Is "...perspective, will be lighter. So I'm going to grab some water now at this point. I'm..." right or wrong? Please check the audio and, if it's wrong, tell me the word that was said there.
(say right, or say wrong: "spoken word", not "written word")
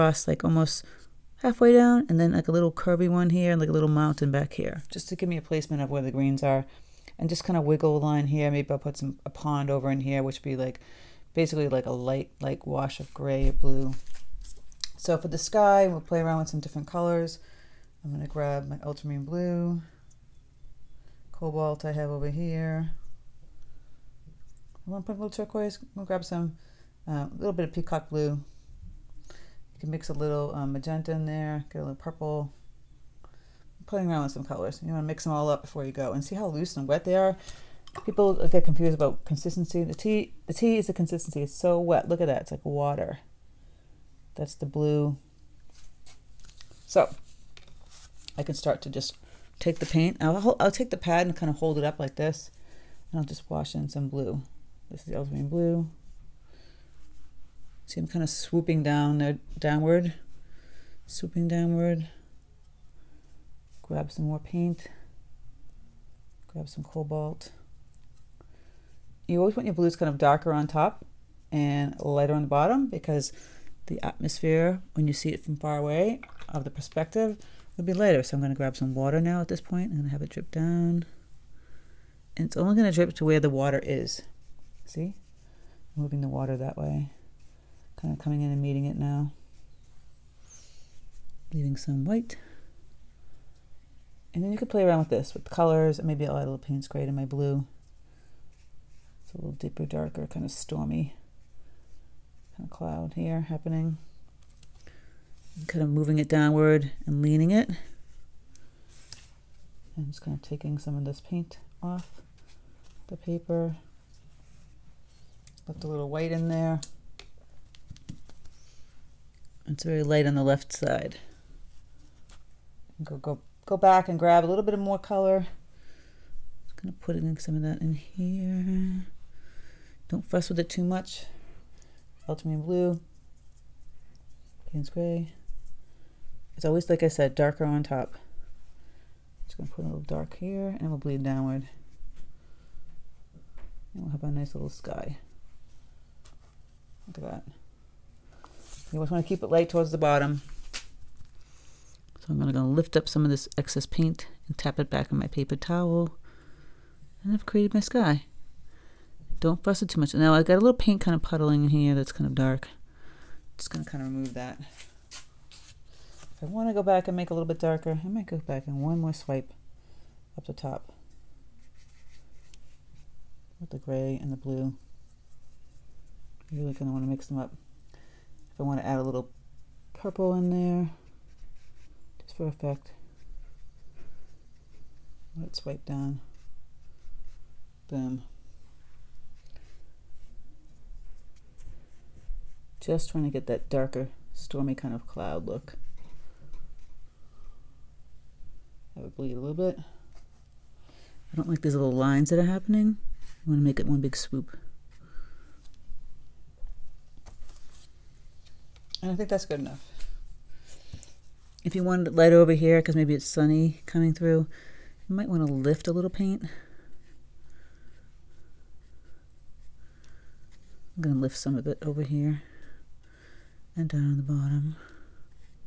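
right.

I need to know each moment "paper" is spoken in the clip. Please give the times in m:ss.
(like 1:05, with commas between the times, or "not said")
1:53, 2:35.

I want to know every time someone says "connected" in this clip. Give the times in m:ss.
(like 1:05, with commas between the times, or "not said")
not said.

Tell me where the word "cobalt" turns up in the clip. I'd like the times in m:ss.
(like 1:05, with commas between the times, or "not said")
0:21, 1:06.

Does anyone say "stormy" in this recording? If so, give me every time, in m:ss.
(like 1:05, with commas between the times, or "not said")
1:40, 3:14.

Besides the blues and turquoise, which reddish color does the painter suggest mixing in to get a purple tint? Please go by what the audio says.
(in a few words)
Magenta.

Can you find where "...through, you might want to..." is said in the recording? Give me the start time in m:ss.
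3:34.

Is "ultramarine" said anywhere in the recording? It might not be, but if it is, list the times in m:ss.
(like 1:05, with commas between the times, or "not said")
0:18, 0:55, 2:12.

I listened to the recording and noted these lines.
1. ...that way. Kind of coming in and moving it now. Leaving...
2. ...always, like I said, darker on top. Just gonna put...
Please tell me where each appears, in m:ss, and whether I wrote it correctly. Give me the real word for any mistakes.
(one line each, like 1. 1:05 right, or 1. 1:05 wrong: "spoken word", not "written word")
1. 1:26 wrong: "meeting", not "moving"
2. 2:16 right.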